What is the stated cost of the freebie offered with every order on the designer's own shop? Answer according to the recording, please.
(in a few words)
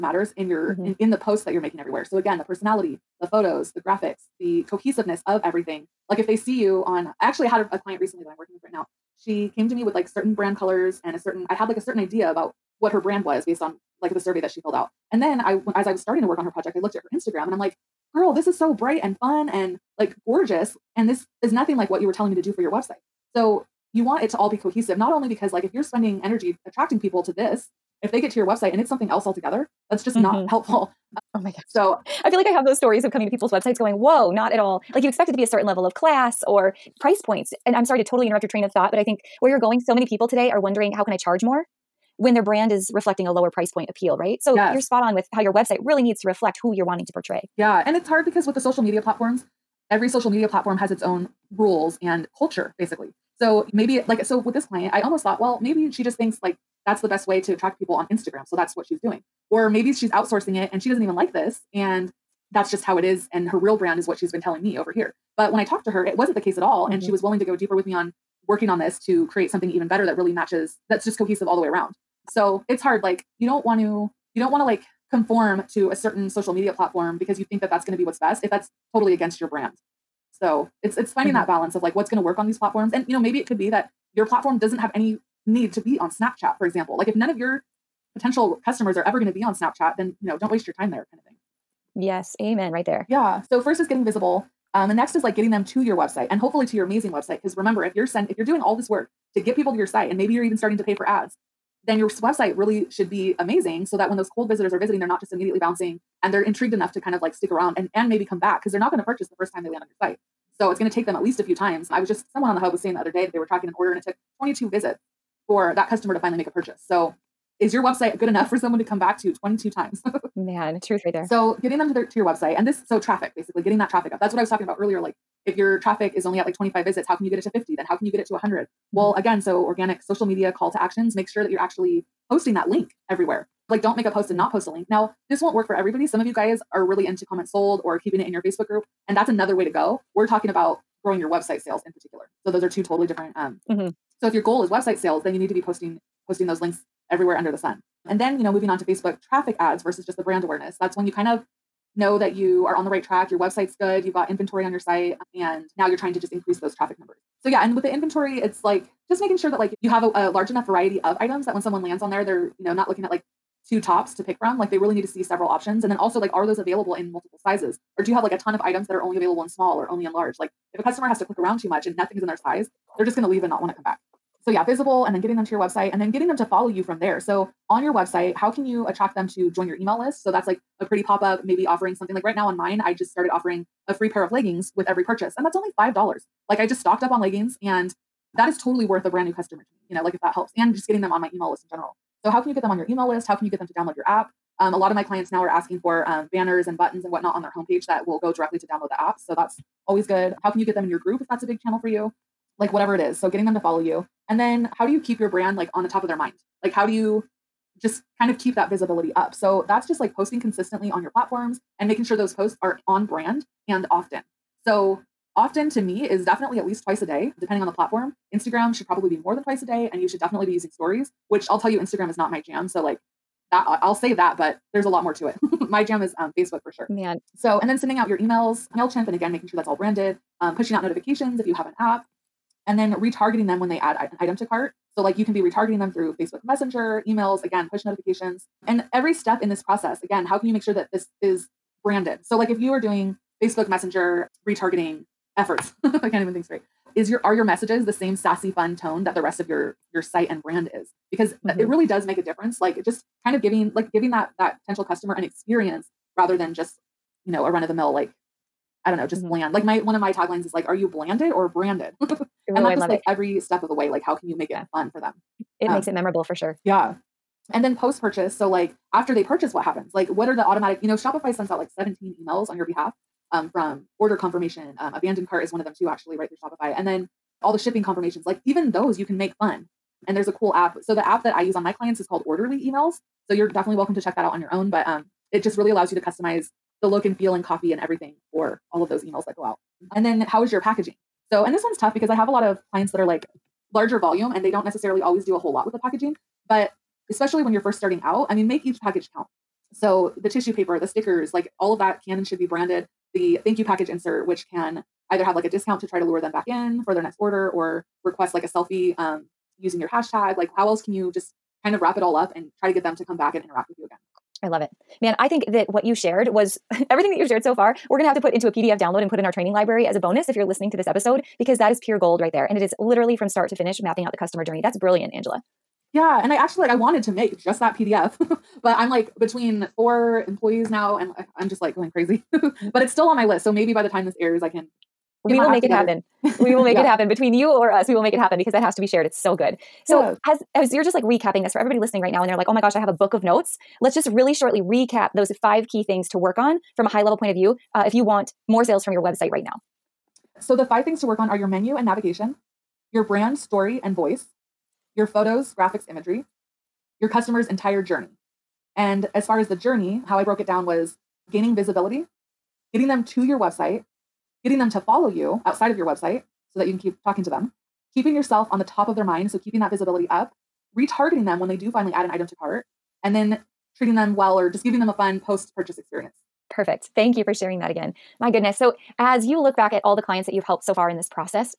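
$5.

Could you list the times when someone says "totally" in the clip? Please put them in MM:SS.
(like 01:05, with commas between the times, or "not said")
00:38, 01:18, 02:22, 03:08.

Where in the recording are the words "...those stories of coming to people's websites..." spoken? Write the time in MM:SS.
00:32.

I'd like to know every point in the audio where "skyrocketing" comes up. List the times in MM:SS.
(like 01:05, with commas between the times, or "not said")
not said.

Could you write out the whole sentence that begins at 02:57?
So on your website, how can you attract them to join your email list?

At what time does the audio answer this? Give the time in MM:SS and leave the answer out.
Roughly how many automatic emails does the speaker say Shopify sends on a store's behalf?
04:31.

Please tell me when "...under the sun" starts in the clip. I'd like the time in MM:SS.
02:27.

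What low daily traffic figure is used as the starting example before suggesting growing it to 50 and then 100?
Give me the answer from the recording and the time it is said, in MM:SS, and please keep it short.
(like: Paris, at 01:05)
25, at 02:06.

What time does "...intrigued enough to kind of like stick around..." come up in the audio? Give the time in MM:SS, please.
01:46.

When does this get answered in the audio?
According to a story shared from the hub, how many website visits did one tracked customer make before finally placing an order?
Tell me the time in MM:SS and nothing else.
01:54.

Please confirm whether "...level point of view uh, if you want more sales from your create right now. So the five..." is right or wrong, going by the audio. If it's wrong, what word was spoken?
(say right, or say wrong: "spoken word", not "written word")
wrong: "website", not "create".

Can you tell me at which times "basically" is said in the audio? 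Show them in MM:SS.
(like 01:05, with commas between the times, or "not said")
00:52, 02:03.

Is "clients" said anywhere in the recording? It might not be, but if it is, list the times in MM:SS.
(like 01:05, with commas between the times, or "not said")
00:07, 00:54, 03:15, 04:41, 04:52, 06:20.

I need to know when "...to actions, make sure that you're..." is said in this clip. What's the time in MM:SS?
02:10.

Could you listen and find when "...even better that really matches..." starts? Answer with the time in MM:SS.
01:09.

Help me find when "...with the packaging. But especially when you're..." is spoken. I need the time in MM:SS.
04:55.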